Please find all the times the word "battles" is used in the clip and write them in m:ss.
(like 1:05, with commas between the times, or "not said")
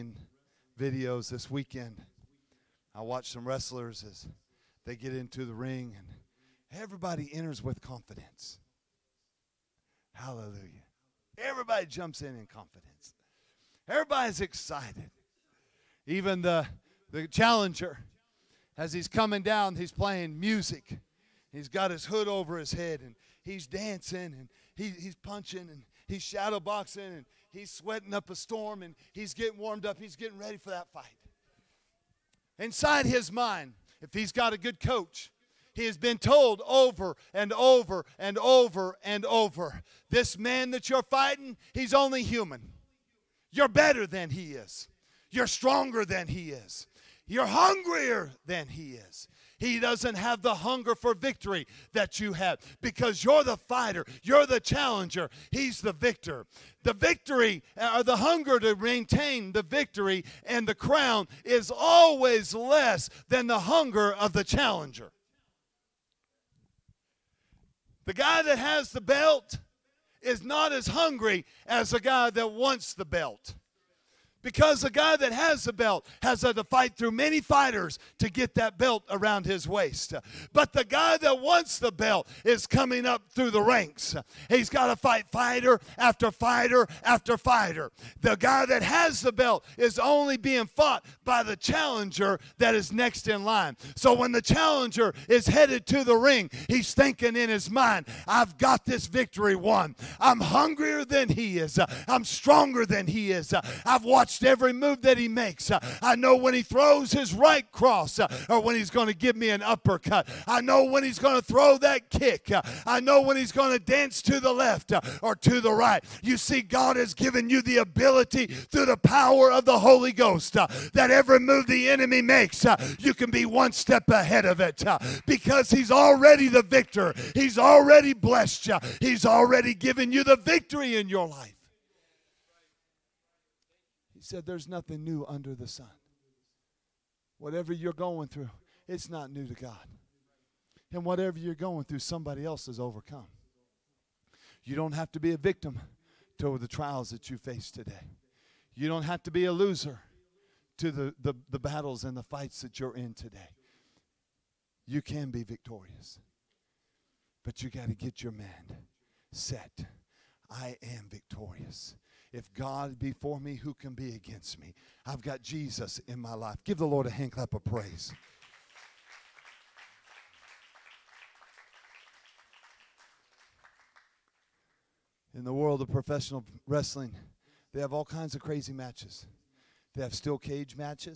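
2:31.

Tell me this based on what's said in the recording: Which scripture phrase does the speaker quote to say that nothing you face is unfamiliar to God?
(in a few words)
There's nothing new under the sun.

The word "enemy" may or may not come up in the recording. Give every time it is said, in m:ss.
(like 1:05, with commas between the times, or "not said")
2:01.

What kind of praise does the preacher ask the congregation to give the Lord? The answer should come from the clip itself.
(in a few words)
A hand clap.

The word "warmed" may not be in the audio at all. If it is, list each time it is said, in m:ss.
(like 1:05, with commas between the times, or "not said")
0:29.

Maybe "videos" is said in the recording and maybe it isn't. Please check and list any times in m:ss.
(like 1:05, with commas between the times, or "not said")
0:00.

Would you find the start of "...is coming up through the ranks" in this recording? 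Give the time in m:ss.
1:22.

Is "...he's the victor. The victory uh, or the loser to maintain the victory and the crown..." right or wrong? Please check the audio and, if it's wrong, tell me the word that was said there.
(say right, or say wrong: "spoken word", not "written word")
wrong: "hunger", not "loser".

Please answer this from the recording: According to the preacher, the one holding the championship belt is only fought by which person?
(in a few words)
the challenger that is next in line.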